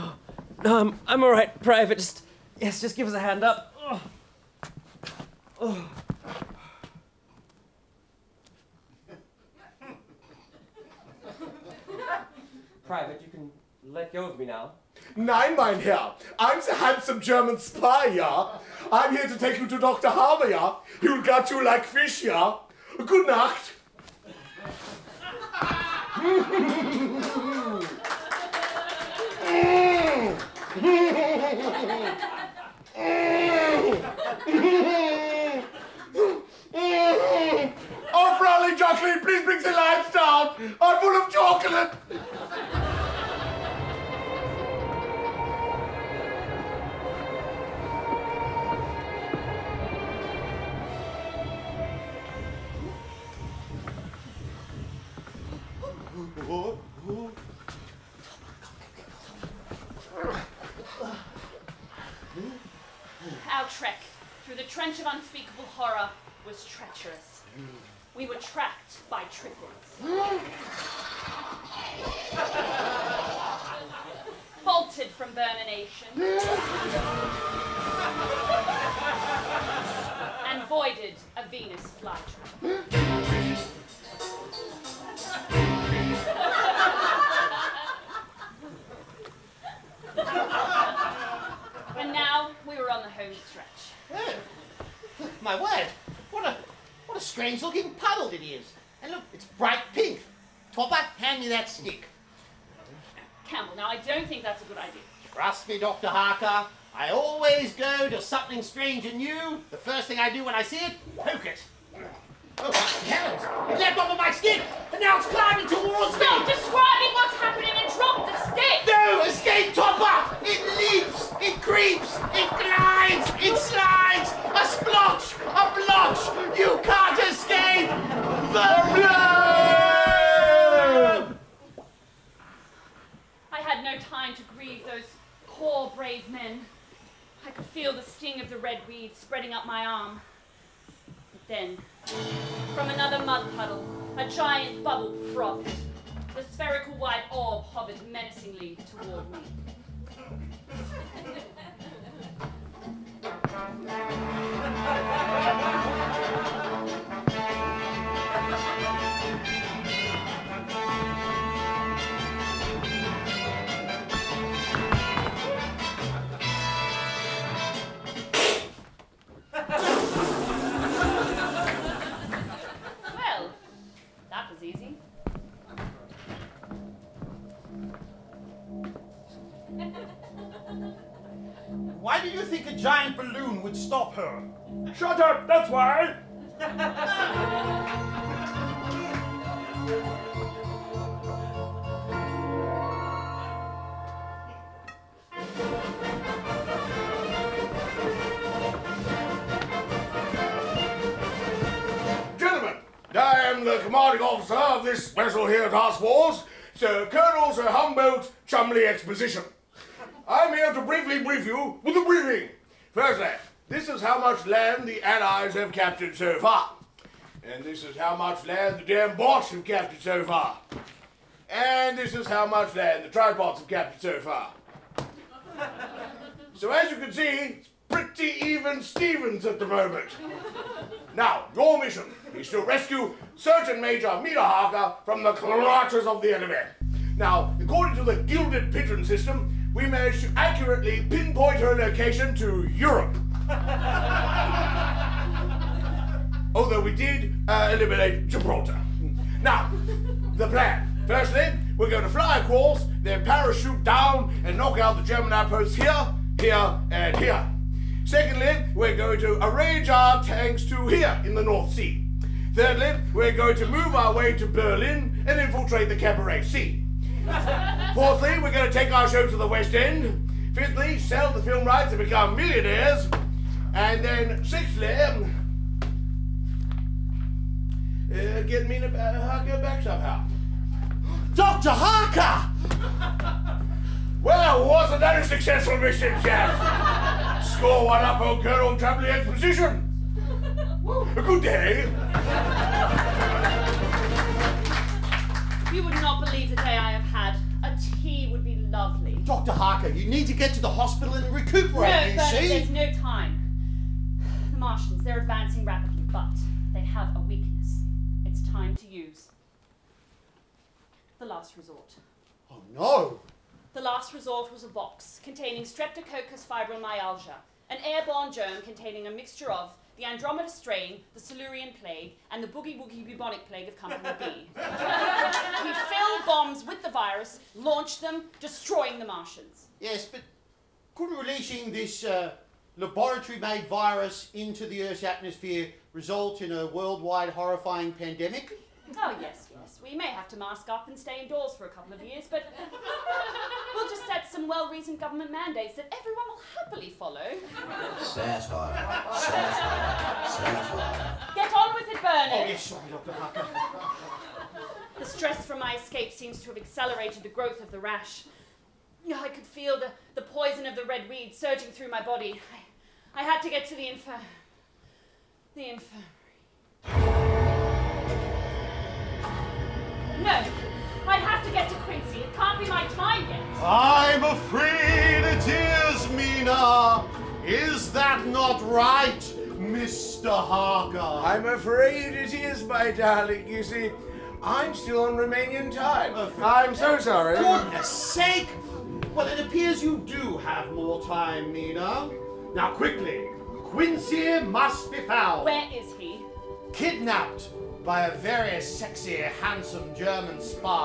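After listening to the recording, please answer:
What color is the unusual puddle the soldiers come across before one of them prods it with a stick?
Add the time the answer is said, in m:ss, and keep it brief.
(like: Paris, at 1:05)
Pink, at 1:39.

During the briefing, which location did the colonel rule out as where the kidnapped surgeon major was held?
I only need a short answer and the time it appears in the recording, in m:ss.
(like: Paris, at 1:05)
Gibraltar, at 4:08.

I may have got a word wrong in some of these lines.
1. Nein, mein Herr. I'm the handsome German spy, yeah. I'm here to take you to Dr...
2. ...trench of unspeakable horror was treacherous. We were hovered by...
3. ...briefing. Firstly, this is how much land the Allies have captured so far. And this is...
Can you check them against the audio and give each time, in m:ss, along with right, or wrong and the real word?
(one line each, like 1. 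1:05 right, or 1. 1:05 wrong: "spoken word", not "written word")
1. 0:15 right
2. 1:04 wrong: "tracked", not "hovered"
3. 3:32 right.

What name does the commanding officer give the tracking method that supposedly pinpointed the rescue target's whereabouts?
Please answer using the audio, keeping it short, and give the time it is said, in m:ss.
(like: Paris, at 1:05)
Gilded Pigeon system, at 3:58.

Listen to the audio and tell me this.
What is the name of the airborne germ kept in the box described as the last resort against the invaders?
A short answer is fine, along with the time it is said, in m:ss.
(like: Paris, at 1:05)
Streptococcus fibromyalgia, at 5:15.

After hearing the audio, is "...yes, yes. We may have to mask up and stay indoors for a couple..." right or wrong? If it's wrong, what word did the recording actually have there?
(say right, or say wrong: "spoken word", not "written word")
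right.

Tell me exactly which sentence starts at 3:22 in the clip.
Gentlemen, I am the commanding officer of this special here task force, Sir Colonel Sir Humboldt Chumley Exposition.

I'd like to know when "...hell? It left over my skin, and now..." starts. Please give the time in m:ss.
1:53.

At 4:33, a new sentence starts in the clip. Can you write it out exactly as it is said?
And then sixthly, um, uh, get Mina Harker back somehow.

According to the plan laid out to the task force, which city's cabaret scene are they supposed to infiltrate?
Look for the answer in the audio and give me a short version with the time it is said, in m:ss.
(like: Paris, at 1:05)
Berlin, at 4:24.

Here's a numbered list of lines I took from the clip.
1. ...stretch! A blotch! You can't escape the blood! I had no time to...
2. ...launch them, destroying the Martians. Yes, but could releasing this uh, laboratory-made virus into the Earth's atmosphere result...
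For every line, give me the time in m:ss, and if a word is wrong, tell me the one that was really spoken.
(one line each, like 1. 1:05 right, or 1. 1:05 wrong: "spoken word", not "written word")
1. 2:04 wrong: "splotch", not "stretch"
2. 5:27 right.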